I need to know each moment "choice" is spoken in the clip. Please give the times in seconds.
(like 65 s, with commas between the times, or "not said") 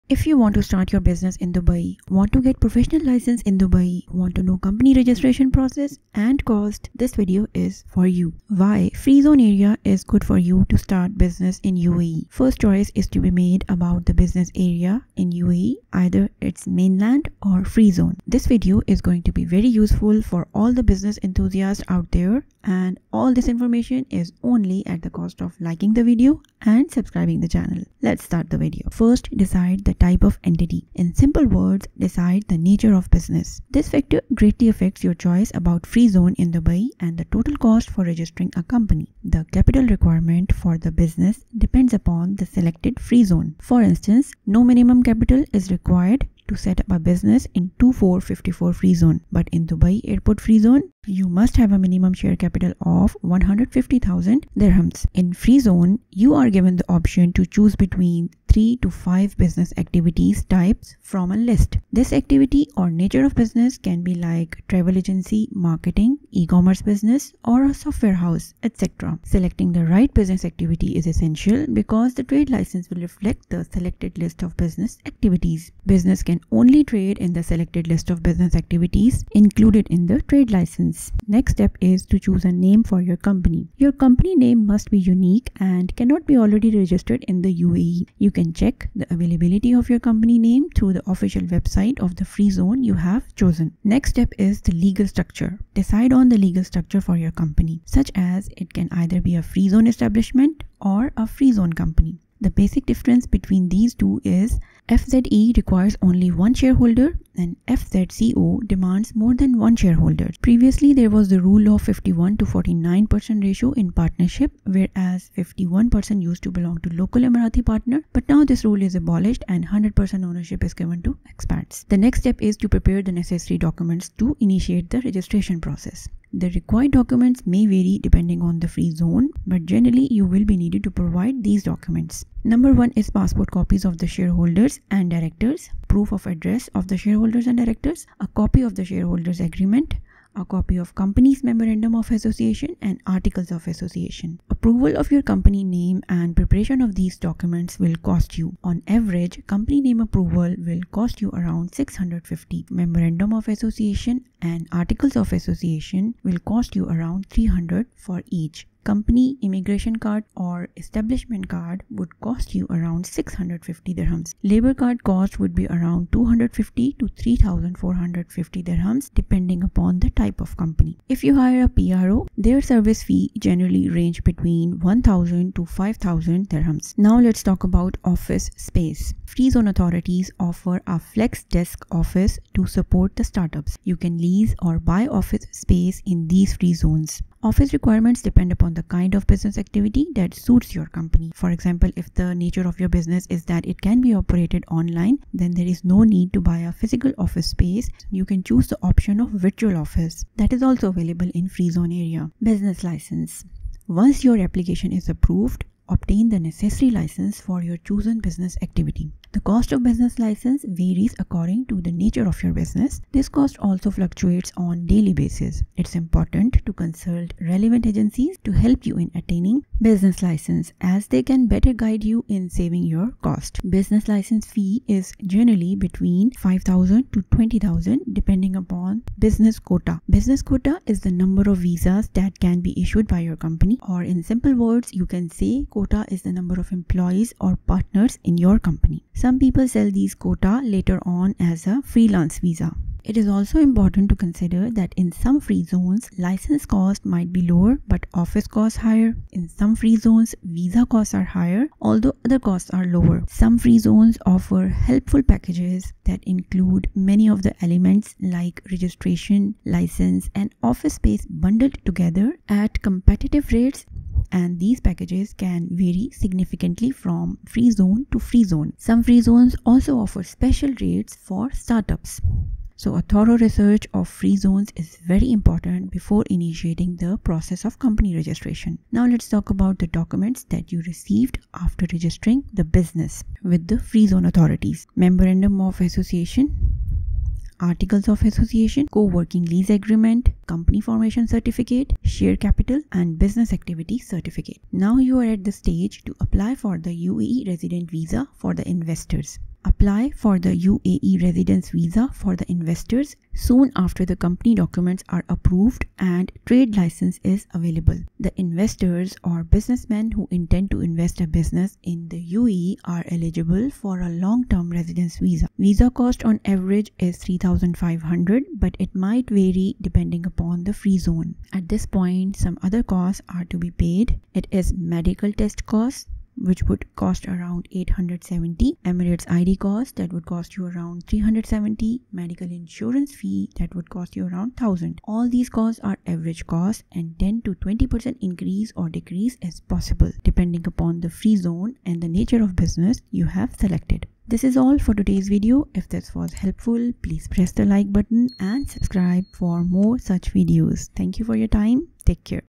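12 s, 35 s.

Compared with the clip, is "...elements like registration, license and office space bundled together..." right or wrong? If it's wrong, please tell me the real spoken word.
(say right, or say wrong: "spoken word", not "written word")
right.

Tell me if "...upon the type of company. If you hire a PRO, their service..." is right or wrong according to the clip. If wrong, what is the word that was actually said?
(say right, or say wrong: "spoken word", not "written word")
right.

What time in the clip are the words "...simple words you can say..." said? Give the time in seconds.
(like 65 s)
234 s.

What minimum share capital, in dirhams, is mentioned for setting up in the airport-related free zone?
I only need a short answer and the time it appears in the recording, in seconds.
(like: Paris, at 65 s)
150,000 dirhams, at 53 s.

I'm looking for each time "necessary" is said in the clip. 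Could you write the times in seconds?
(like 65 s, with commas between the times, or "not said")
123 s, 206 s.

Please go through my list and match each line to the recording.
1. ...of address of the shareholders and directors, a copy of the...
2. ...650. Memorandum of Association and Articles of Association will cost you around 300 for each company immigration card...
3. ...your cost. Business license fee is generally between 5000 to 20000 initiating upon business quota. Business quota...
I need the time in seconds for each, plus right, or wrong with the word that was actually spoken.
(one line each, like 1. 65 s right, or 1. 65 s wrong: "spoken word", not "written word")
1. 136 s right
2. 151 s right
3. 222 s wrong: "depending", not "initiating".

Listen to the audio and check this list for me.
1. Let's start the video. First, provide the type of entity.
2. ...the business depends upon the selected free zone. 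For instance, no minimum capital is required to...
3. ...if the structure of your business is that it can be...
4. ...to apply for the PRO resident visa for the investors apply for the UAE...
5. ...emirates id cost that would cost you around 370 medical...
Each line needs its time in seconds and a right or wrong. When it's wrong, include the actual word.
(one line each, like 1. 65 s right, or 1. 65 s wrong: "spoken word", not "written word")
1. 28 s wrong: "decide", not "provide"
2. 40 s right
3. 191 s wrong: "nature", not "structure"
4. 296 s wrong: "UAE", not "PRO"
5. 328 s right.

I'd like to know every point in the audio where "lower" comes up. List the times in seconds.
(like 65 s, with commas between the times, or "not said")
247 s, 252 s.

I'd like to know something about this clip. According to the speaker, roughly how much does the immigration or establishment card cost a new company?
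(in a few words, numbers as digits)
650 dirhams.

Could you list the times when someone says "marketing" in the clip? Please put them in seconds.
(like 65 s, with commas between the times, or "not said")
65 s.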